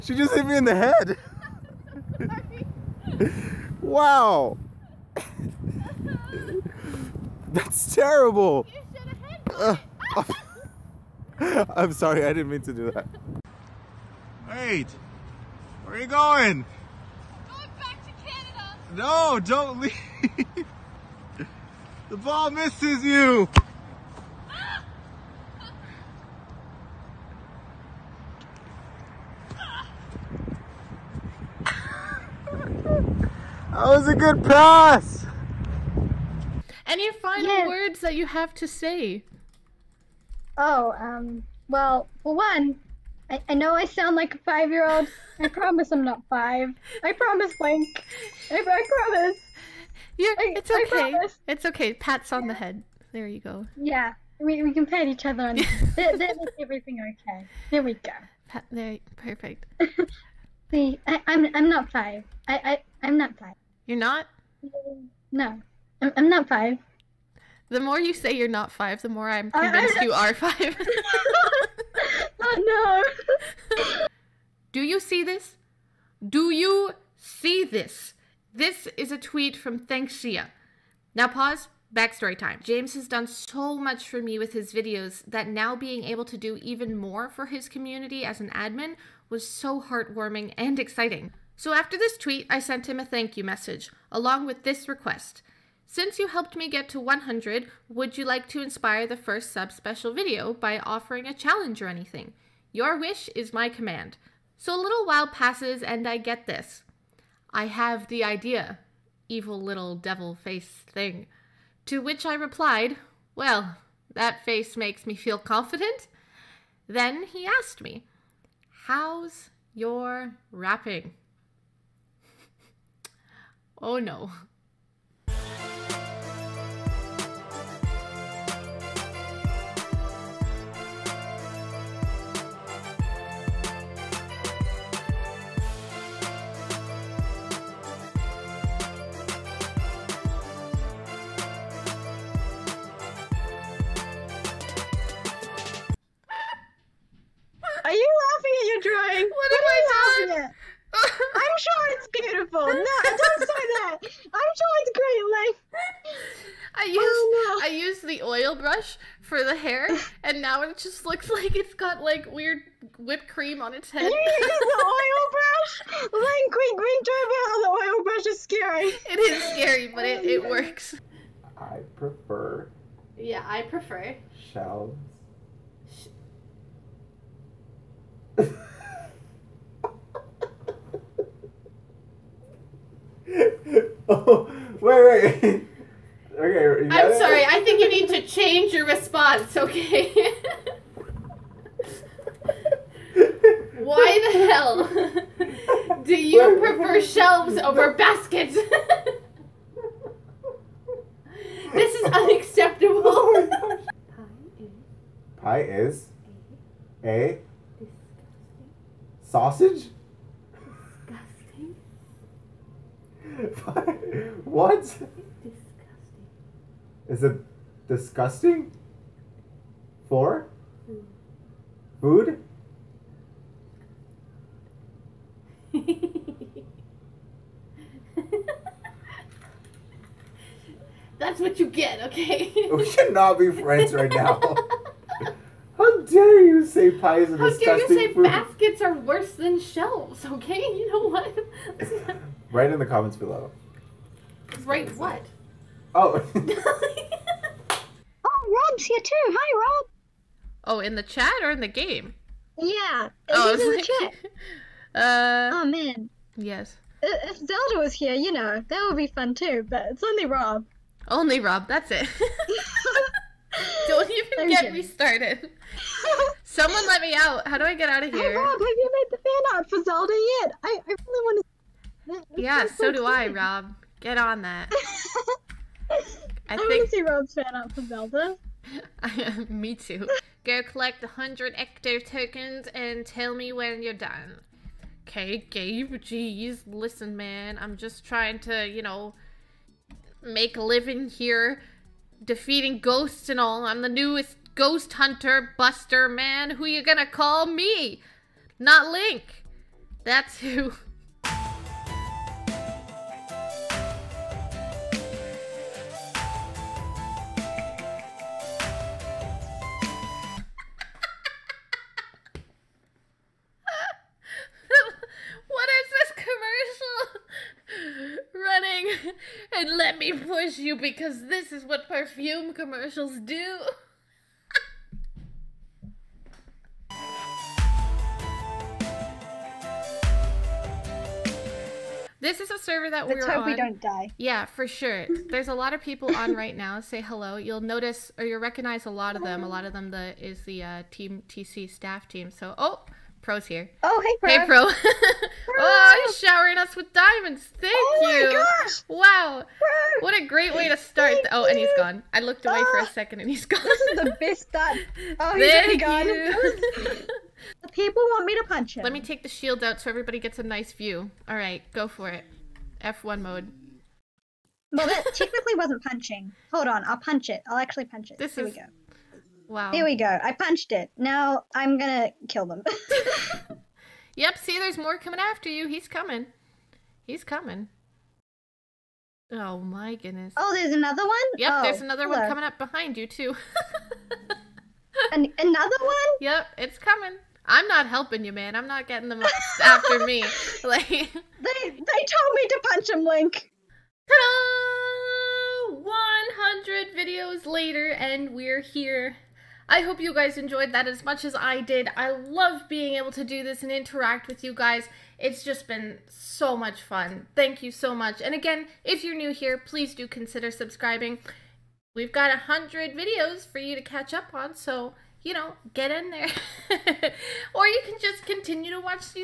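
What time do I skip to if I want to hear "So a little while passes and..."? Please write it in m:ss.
1:44.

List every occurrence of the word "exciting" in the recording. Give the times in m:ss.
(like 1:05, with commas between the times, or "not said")
1:30.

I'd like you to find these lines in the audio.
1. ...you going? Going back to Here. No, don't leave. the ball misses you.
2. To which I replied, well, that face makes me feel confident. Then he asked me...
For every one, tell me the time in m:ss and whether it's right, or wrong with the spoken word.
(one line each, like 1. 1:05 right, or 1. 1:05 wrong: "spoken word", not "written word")
1. 0:15 wrong: "Canada", not "Here"
2. 1:51 right.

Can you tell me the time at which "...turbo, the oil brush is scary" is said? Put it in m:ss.
2:47.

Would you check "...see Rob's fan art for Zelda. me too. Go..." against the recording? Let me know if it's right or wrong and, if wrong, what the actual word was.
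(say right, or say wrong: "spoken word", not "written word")
right.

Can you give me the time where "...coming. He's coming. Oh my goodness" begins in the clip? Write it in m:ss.
6:15.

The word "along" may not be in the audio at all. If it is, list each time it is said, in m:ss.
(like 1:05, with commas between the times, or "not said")
1:34.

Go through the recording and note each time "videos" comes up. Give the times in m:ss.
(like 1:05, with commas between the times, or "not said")
1:24, 1:40, 6:36, 6:52.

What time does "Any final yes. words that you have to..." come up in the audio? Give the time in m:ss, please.
0:36.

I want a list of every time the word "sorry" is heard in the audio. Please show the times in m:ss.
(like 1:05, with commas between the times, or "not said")
0:11, 3:07.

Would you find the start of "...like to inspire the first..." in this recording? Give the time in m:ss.
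1:38.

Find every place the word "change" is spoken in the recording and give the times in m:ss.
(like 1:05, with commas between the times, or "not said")
3:08.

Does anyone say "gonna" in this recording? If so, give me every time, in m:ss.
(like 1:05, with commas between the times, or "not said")
4:56, 6:11.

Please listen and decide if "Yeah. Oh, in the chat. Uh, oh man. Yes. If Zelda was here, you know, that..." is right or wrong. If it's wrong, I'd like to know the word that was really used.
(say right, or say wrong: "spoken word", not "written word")
right.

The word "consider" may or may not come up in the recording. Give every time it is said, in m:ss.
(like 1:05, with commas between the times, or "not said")
6:50.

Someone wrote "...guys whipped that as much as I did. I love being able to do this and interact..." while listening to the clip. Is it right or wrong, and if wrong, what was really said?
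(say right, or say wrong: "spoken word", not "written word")
wrong: "enjoyed", not "whipped".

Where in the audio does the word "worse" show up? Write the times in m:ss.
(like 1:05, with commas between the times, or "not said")
3:58.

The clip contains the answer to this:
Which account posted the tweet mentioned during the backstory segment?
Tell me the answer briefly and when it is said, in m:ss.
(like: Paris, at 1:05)
ThnxCya, at 1:19.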